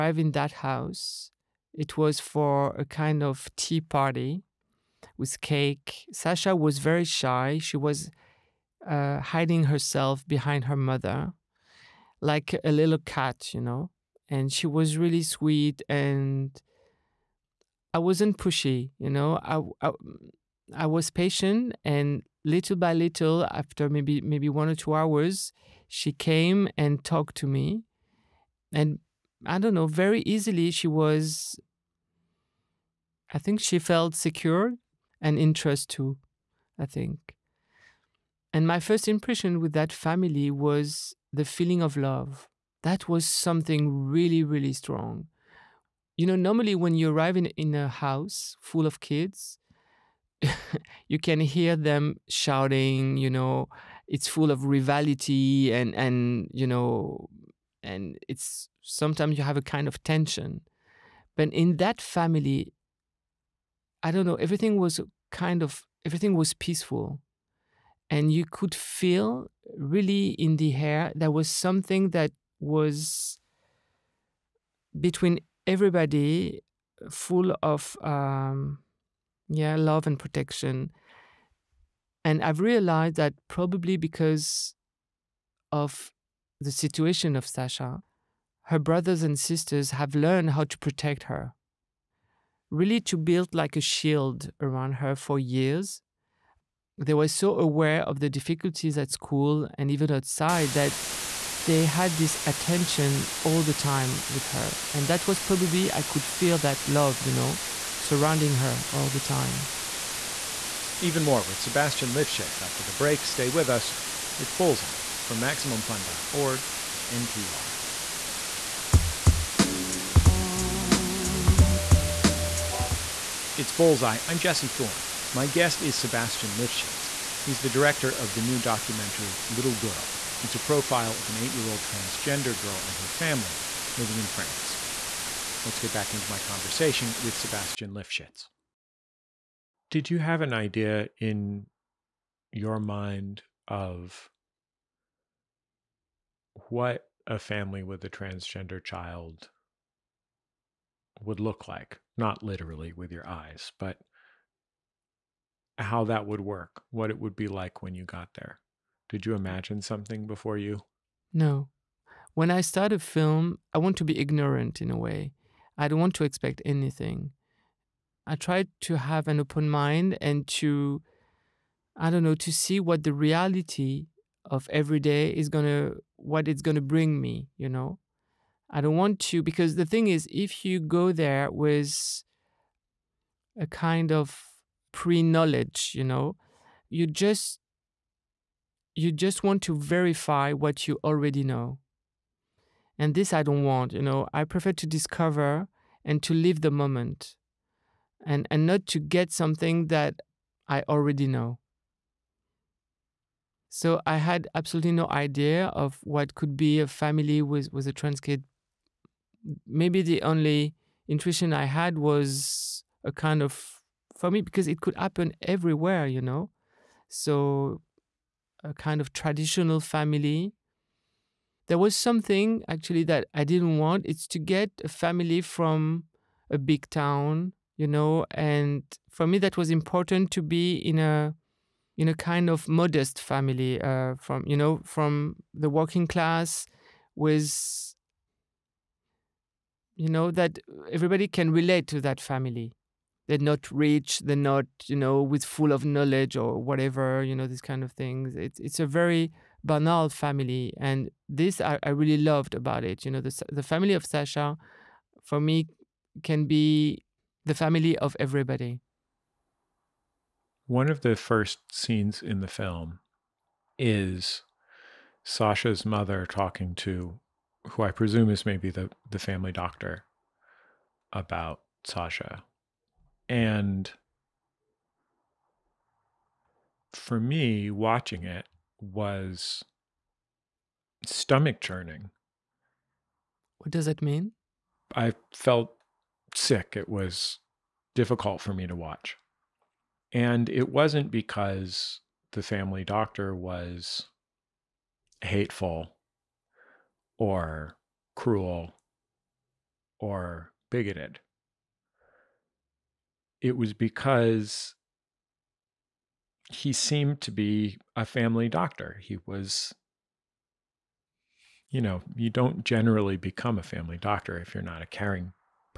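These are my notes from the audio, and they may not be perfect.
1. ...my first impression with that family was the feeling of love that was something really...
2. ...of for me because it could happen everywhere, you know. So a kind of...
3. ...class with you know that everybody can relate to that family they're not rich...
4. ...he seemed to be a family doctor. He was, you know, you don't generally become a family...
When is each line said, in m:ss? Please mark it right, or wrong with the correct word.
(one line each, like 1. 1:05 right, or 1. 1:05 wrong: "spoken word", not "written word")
1. 0:38 right
2. 3:33 right
3. 3:56 right
4. 5:06 right.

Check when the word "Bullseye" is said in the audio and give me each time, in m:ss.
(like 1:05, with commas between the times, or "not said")
1:54, 2:03.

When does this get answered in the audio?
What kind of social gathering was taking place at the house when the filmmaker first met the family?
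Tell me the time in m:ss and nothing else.
0:03.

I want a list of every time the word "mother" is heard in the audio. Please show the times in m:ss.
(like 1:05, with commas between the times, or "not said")
0:10, 4:25.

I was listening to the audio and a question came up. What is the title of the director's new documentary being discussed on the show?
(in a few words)
Little Girl.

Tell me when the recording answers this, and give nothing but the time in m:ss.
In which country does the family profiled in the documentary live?
2:14.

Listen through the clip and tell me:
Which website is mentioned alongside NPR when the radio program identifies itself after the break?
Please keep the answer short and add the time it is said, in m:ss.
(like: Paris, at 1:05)
MaximumFun.org, at 1:55.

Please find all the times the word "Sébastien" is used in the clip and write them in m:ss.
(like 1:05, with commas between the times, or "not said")
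1:51, 2:05, 2:17.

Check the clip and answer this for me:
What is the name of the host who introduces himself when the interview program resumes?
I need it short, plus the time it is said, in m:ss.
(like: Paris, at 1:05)
Jesse Thorn, at 2:04.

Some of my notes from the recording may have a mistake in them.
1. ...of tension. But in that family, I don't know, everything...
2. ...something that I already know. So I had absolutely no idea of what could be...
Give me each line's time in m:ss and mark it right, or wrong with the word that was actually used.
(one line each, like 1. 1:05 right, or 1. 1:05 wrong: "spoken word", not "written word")
1. 0:59 right
2. 3:19 right.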